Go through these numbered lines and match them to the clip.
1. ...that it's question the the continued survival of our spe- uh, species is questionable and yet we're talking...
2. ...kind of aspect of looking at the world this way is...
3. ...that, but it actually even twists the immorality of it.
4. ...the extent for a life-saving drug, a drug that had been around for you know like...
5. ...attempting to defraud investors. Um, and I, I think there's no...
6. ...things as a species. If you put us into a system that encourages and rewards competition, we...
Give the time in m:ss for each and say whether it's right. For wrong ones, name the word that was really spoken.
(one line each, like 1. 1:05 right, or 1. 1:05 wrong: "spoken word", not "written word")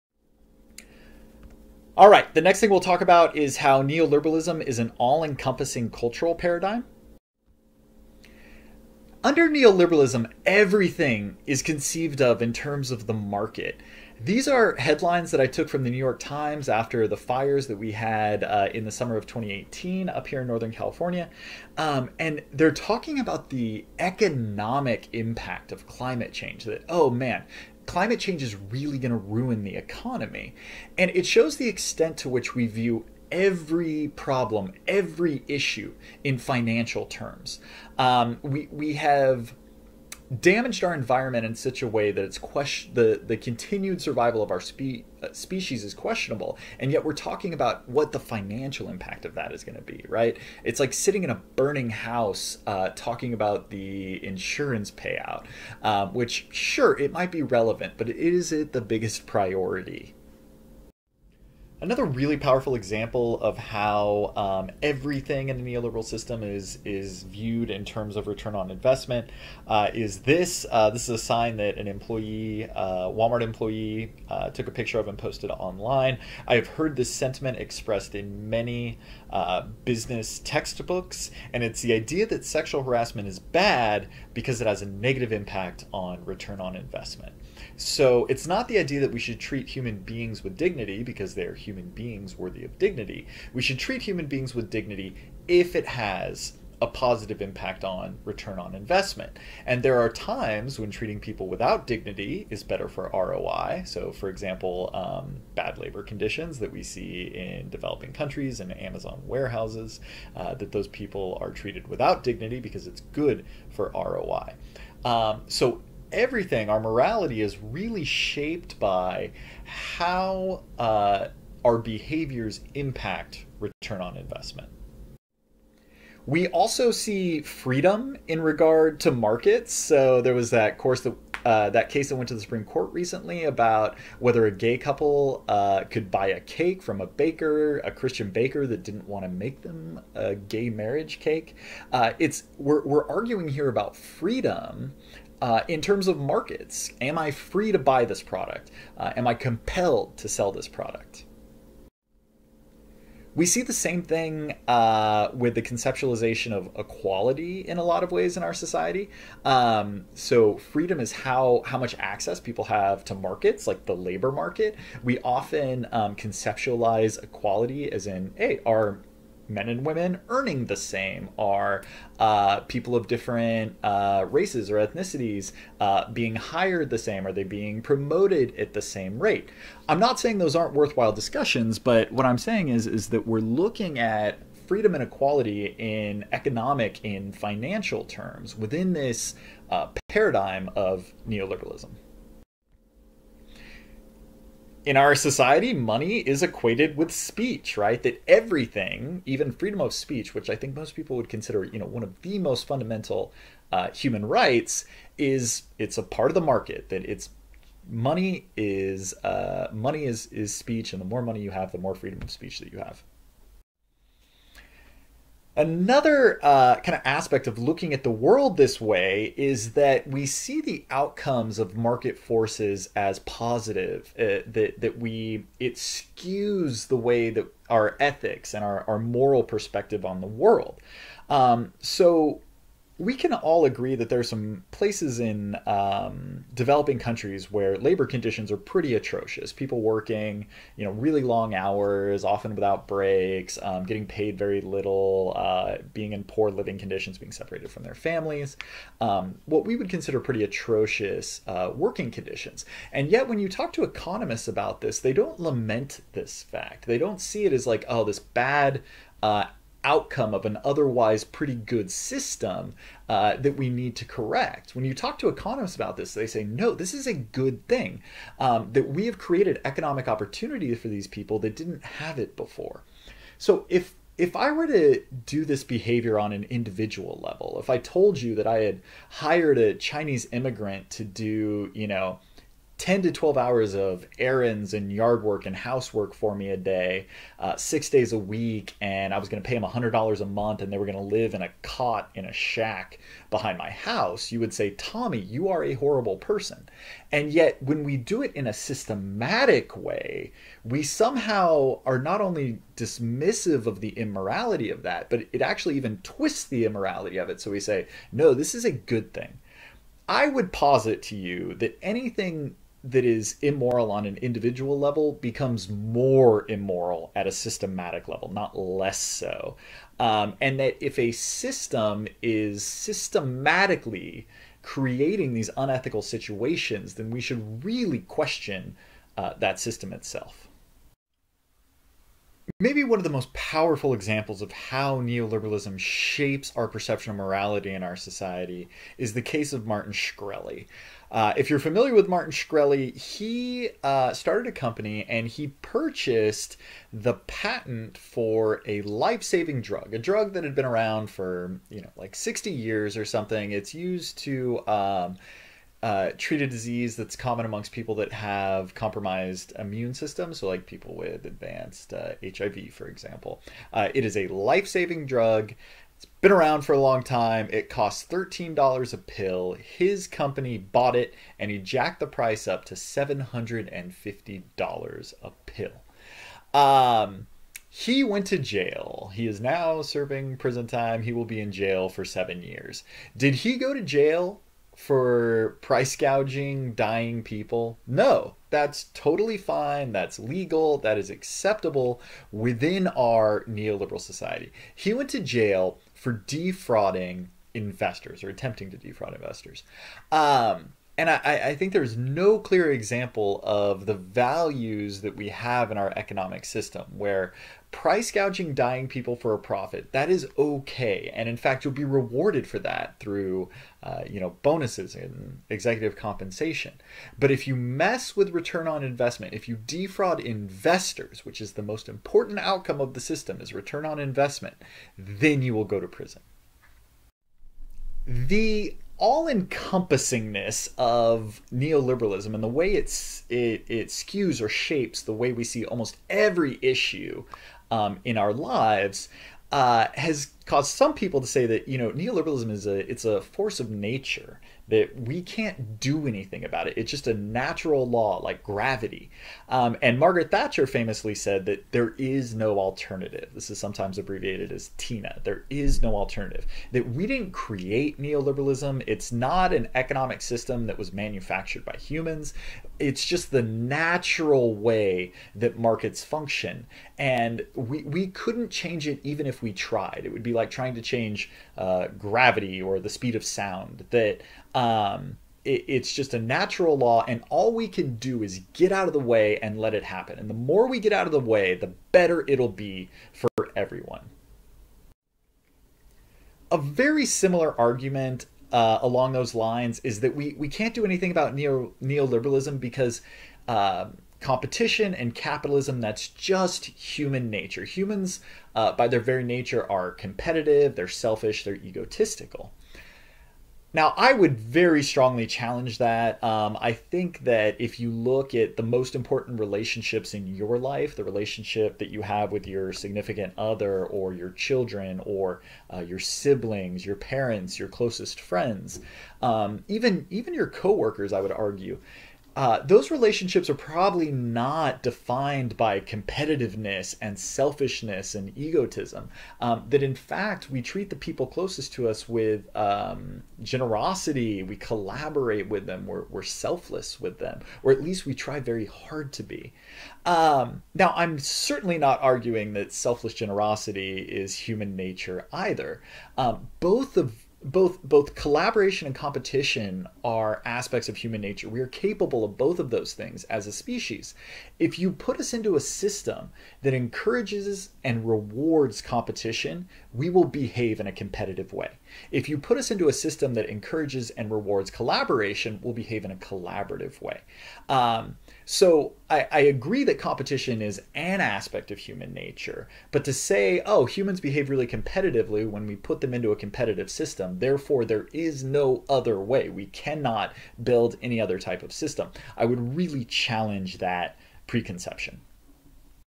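1. 0:42 right
2. 3:36 right
3. 5:04 right
4. 5:46 wrong: "patent", not "extent"
5. 6:38 right
6. 9:12 right.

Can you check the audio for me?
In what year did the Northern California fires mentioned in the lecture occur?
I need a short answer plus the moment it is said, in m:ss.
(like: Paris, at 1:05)
2018, at 0:19.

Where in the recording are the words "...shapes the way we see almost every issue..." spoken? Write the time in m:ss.
7:14.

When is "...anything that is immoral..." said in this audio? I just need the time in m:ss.
5:11.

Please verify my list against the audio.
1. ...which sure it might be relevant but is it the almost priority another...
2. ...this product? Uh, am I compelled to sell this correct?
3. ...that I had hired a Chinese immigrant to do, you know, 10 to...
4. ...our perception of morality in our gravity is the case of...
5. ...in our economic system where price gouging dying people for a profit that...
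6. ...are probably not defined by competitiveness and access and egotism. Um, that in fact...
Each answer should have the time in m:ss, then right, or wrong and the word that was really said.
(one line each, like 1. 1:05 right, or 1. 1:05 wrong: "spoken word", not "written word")
1. 0:56 wrong: "biggest", not "almost"
2. 2:28 wrong: "product", not "correct"
3. 4:38 right
4. 5:36 wrong: "society", not "gravity"
5. 6:45 right
6. 8:43 wrong: "selfishness", not "access".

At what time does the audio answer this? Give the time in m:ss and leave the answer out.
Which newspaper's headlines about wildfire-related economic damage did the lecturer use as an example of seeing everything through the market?
0:15.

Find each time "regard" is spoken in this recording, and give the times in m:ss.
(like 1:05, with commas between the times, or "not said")
2:08.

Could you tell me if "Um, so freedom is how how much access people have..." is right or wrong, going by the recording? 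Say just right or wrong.
right.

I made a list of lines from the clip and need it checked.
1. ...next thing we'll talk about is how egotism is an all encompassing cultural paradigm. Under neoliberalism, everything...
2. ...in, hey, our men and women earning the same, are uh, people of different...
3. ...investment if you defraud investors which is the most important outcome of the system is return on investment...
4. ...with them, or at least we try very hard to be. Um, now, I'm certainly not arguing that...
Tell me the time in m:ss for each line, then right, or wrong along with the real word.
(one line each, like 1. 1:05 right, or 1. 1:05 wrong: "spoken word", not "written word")
1. 0:02 wrong: "neoliberalism", not "egotism"
2. 2:48 right
3. 6:58 right
4. 8:57 right.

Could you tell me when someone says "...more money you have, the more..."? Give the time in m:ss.
3:31.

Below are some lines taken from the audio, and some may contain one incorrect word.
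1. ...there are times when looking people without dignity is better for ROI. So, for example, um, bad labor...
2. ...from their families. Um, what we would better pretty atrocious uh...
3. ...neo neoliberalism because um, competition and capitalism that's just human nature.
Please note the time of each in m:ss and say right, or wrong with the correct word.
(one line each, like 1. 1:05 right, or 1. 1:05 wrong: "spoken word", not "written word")
1. 1:39 wrong: "treating", not "looking"
2. 4:07 wrong: "consider", not "better"
3. 8:11 right.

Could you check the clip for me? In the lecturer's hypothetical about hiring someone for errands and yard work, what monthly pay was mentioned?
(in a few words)
$100.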